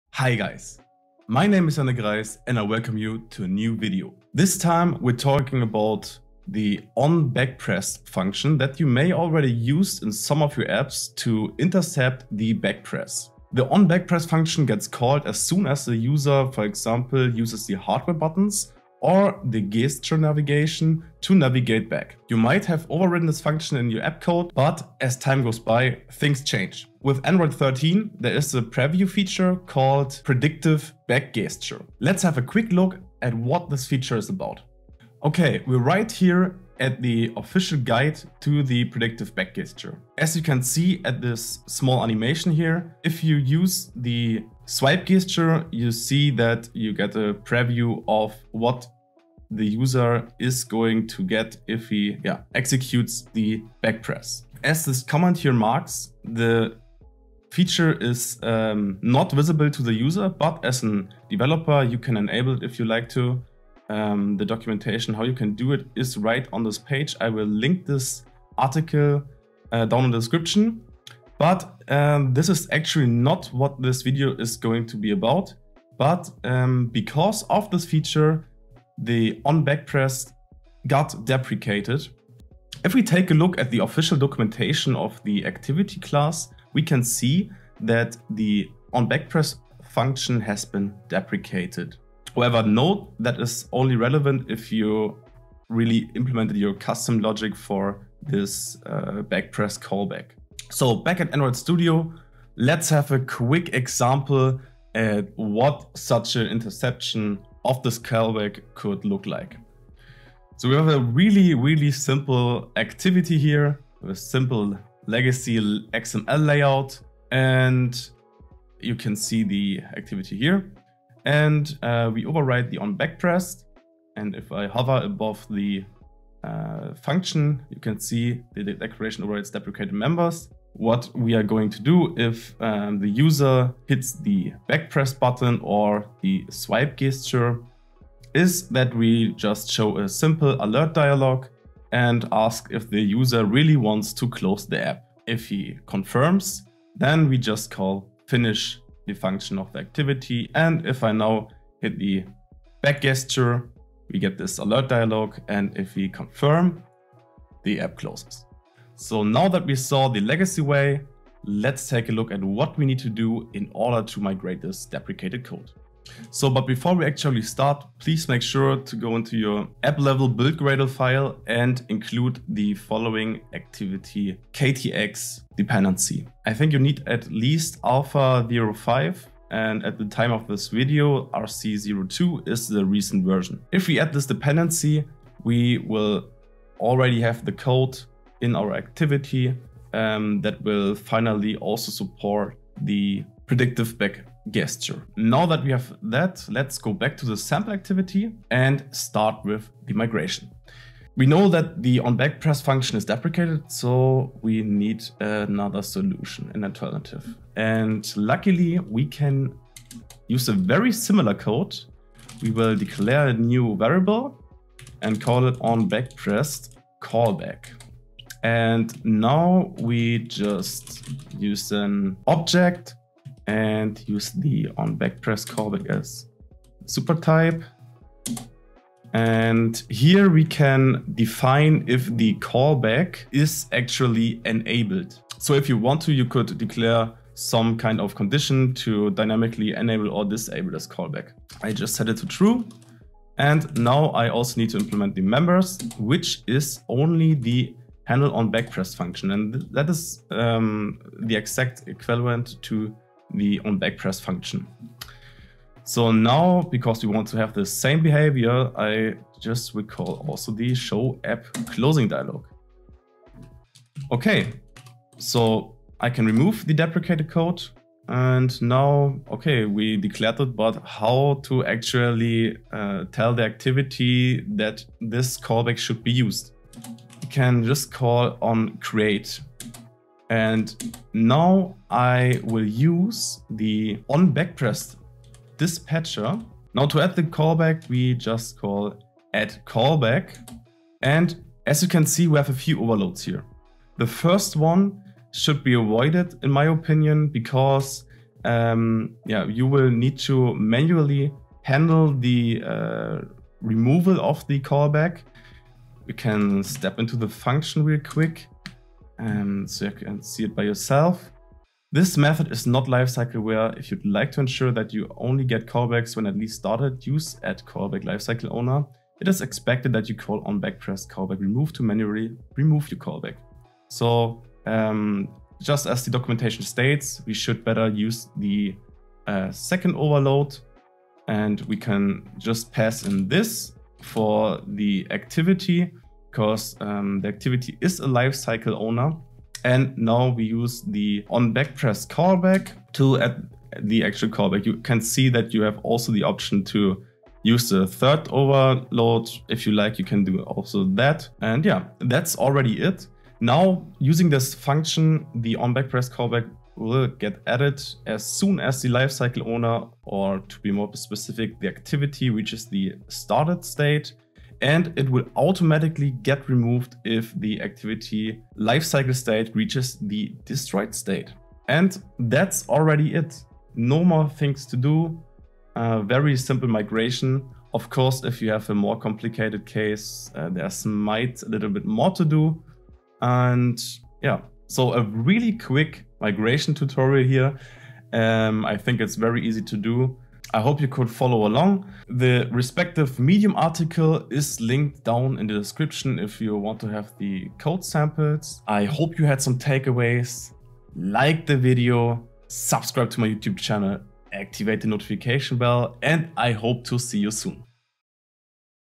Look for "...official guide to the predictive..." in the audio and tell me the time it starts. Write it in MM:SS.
00:37.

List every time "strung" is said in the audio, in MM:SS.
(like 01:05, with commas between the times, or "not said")
not said.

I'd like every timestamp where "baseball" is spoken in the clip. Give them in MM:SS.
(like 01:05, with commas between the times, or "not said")
not said.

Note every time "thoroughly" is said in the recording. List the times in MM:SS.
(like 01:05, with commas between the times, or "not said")
not said.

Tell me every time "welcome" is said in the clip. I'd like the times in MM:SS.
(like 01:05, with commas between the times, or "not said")
00:02.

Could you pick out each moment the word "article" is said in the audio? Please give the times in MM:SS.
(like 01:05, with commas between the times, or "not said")
01:08, 06:33.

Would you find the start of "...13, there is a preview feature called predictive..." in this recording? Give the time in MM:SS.
00:27.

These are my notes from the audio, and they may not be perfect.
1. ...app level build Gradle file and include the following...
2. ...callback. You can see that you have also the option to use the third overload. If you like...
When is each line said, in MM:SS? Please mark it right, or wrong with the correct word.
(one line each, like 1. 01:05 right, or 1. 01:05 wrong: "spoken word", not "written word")
1. 02:49 right
2. 05:44 right.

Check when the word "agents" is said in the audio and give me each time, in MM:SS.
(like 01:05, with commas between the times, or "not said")
not said.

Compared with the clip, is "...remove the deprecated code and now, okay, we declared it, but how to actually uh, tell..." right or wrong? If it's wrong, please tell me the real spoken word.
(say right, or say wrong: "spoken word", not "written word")
right.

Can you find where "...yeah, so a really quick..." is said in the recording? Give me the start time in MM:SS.
06:24.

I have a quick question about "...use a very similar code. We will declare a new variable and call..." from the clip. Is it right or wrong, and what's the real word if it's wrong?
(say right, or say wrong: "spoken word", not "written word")
right.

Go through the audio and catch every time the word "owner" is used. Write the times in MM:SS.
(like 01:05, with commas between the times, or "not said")
05:18, 05:38, 05:59.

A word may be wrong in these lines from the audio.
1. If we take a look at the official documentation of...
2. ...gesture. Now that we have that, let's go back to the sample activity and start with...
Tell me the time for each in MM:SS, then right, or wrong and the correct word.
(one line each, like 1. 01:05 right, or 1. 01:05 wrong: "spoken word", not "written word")
1. 01:22 right
2. 03:14 right.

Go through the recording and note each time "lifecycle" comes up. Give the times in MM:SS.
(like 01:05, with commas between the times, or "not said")
05:12, 05:18, 05:38, 05:58, 06:08.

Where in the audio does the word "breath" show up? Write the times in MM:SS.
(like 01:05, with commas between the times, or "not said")
not said.